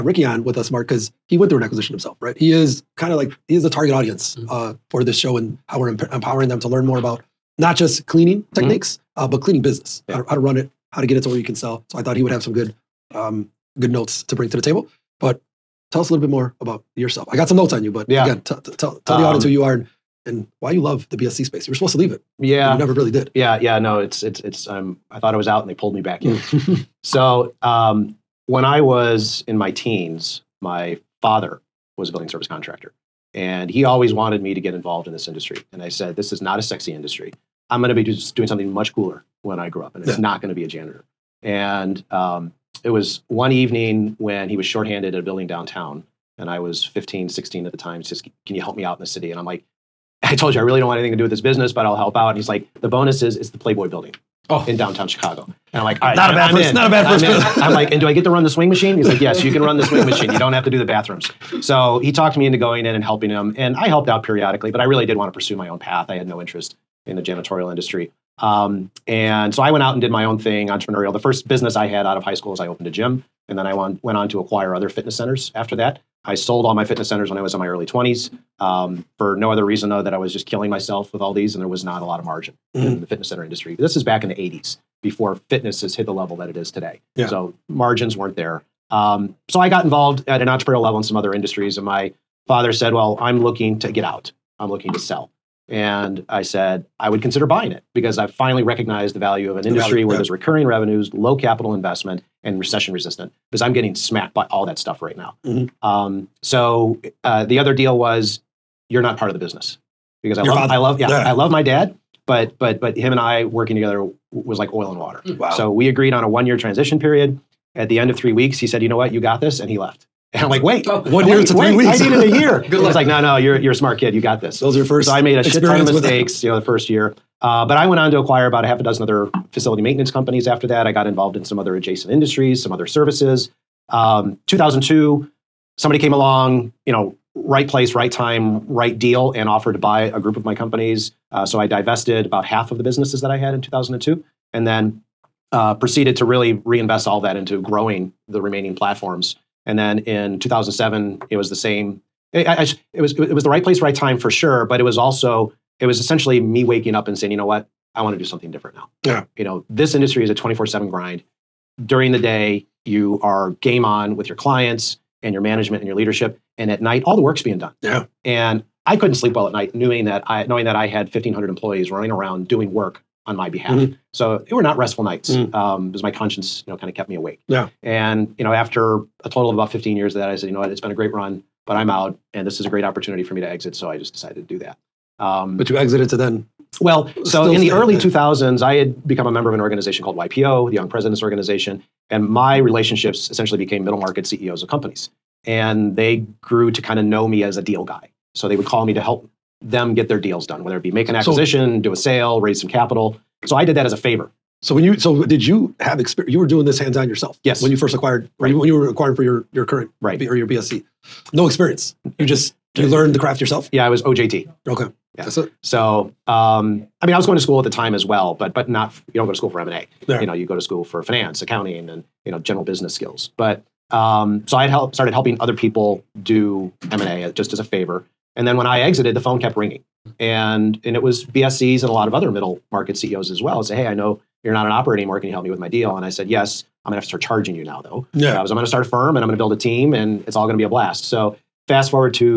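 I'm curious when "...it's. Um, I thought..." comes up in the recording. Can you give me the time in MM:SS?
00:24.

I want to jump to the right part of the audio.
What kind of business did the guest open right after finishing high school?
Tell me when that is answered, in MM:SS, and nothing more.
01:12.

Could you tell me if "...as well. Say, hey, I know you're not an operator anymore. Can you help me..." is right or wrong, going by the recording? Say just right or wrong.
right.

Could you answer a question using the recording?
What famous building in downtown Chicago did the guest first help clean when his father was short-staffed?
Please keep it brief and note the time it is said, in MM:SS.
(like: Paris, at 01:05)
The Playboy building, at 00:53.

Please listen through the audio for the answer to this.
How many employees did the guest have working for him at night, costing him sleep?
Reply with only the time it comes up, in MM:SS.
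02:51.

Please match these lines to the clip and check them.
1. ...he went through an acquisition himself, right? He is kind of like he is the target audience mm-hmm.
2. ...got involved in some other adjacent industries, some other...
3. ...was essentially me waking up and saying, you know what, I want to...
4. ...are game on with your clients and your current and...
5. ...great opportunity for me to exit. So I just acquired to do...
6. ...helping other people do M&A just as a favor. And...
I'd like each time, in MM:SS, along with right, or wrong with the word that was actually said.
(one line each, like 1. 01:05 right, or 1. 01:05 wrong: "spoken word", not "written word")
1. 00:01 right
2. 02:10 right
3. 02:35 right
4. 02:43 wrong: "management", not "current"
5. 03:02 wrong: "decided", not "acquired"
6. 03:45 right.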